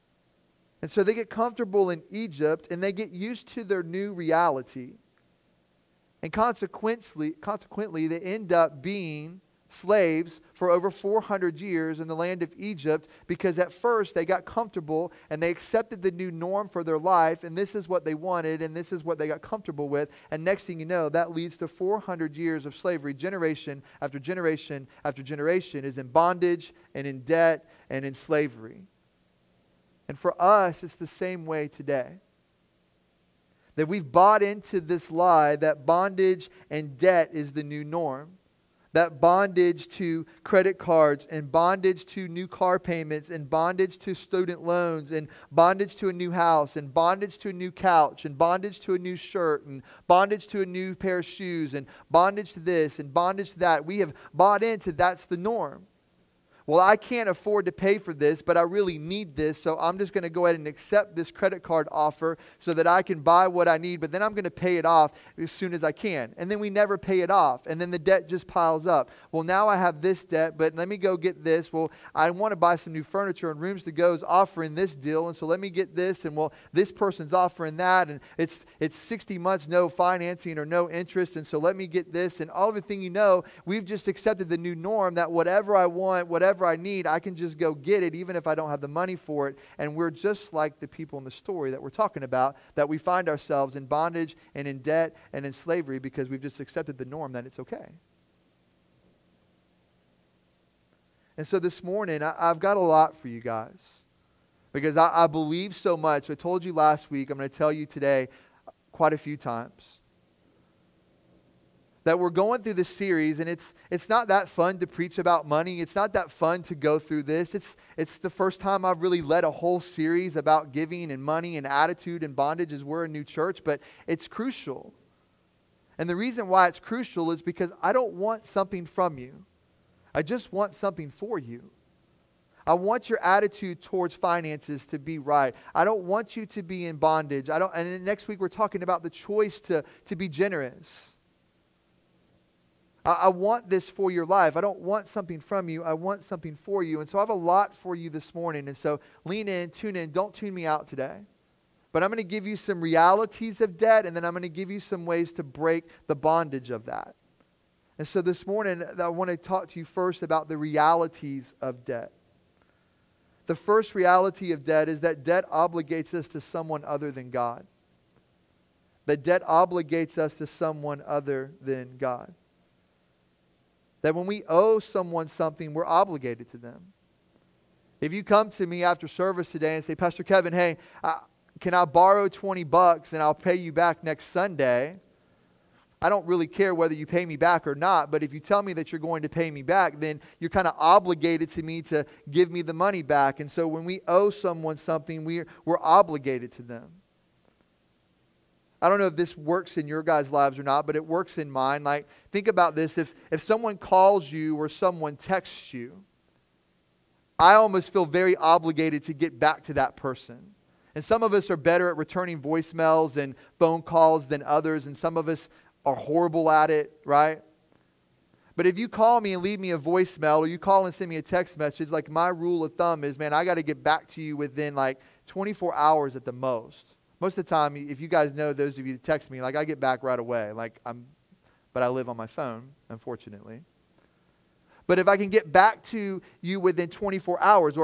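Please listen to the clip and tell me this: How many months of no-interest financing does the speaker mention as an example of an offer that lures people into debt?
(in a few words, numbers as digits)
60.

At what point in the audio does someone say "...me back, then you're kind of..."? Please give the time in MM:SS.
03:09.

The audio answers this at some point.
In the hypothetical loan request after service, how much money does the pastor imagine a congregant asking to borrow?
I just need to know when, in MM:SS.
03:02.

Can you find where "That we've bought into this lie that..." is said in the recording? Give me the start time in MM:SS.
00:33.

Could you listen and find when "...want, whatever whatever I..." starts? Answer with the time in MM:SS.
01:25.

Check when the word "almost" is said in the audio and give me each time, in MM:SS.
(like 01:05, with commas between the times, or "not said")
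03:27.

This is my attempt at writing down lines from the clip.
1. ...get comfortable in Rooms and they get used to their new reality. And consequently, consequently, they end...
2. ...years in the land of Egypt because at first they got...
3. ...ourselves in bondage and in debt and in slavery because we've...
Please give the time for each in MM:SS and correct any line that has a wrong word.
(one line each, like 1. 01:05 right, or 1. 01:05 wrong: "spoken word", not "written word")
1. 00:01 wrong: "Egypt", not "Rooms"
2. 00:11 right
3. 01:33 right.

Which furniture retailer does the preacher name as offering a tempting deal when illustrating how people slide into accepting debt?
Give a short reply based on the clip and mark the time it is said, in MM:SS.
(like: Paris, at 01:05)
Rooms to Go, at 01:13.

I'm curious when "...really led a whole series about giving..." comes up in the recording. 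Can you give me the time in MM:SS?
01:59.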